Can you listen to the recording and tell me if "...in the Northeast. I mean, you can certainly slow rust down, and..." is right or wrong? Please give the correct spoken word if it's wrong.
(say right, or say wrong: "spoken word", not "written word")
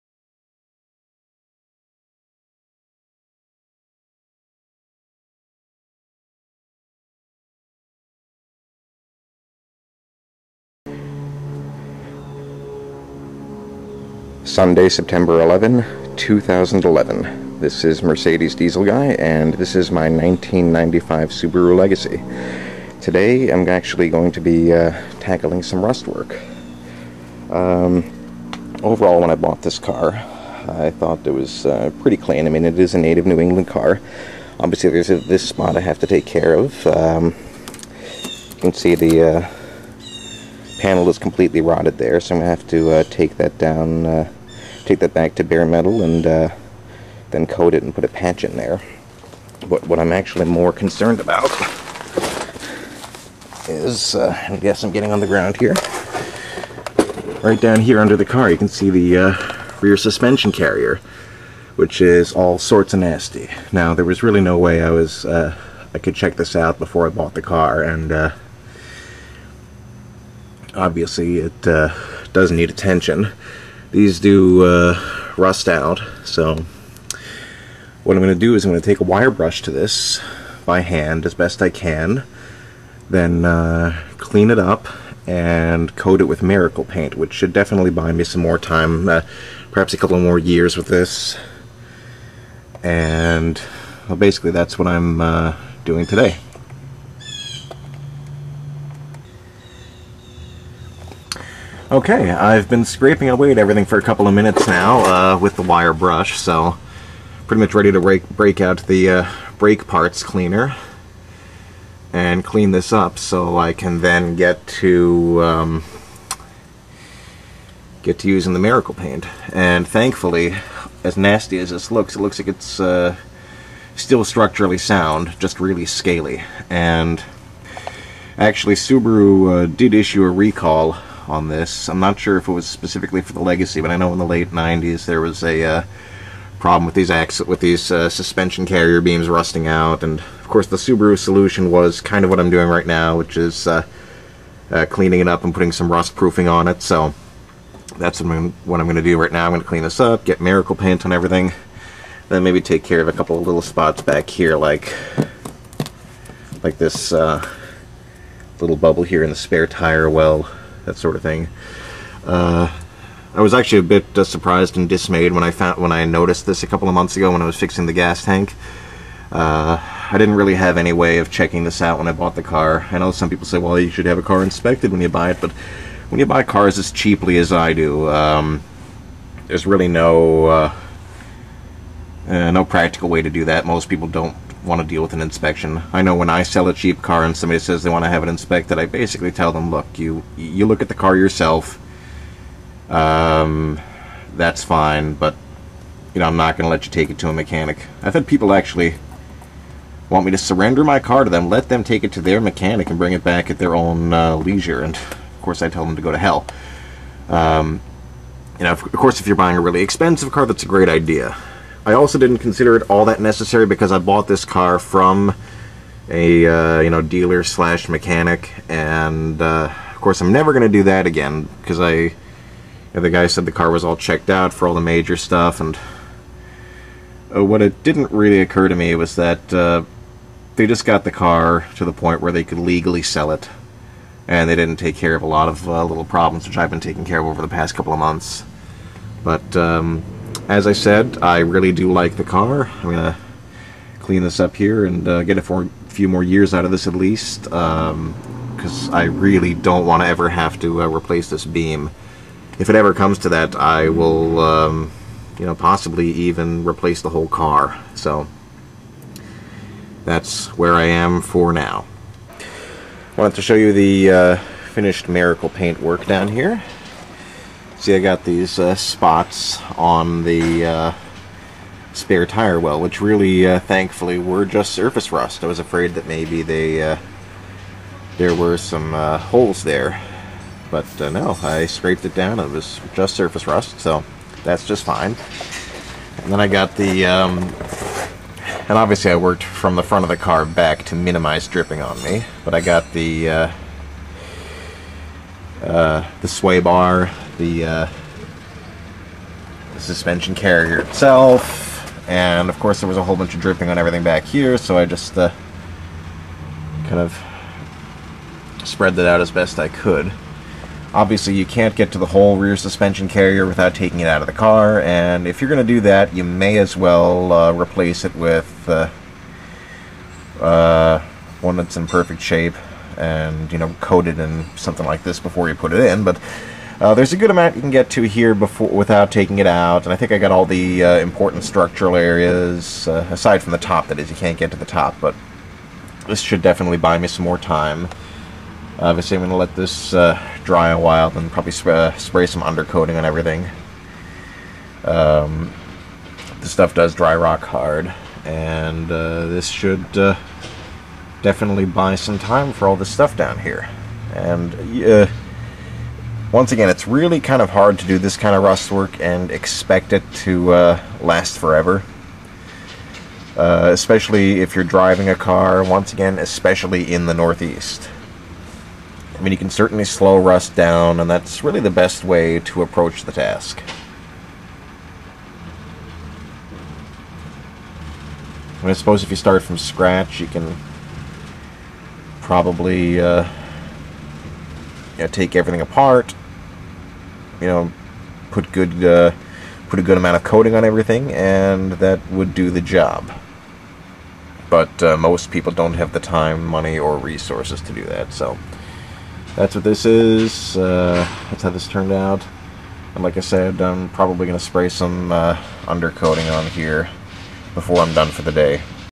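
right.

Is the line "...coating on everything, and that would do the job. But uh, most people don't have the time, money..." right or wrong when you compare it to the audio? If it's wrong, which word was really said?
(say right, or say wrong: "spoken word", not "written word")
right.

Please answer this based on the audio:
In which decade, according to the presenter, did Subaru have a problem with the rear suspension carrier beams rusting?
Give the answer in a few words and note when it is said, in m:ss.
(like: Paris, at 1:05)
Late 90s, at 2:14.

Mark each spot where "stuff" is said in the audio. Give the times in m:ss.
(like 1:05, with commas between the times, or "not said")
3:45, 5:46, 5:52.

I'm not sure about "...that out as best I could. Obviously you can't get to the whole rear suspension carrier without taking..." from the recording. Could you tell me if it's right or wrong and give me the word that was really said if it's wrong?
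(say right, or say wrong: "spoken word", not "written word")
right.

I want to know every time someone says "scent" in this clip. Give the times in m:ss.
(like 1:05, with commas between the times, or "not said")
not said.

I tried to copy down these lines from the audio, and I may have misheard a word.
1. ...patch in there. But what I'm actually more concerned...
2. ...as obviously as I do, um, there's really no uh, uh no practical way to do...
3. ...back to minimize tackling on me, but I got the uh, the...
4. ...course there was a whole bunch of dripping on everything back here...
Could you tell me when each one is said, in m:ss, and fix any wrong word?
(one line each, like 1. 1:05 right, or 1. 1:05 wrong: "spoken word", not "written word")
1. 0:48 right
2. 2:56 wrong: "cheaply", not "obviously"
3. 4:50 wrong: "dripping", not "tackling"
4. 5:02 right.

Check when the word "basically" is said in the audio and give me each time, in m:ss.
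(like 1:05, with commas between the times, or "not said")
1:34, 3:08.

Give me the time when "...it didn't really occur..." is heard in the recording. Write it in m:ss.
3:47.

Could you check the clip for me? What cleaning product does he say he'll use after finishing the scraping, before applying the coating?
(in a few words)
Brake parts cleaner.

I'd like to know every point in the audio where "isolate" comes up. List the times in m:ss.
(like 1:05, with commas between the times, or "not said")
not said.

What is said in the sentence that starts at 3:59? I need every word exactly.
Um, as I said, I really do like the car.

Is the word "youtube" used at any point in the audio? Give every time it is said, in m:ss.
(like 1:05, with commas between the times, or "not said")
not said.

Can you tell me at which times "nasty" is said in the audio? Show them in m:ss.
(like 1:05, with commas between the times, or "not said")
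1:03, 2:01.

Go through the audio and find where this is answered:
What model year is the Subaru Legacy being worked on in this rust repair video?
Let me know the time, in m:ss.
0:20.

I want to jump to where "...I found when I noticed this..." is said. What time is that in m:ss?
2:45.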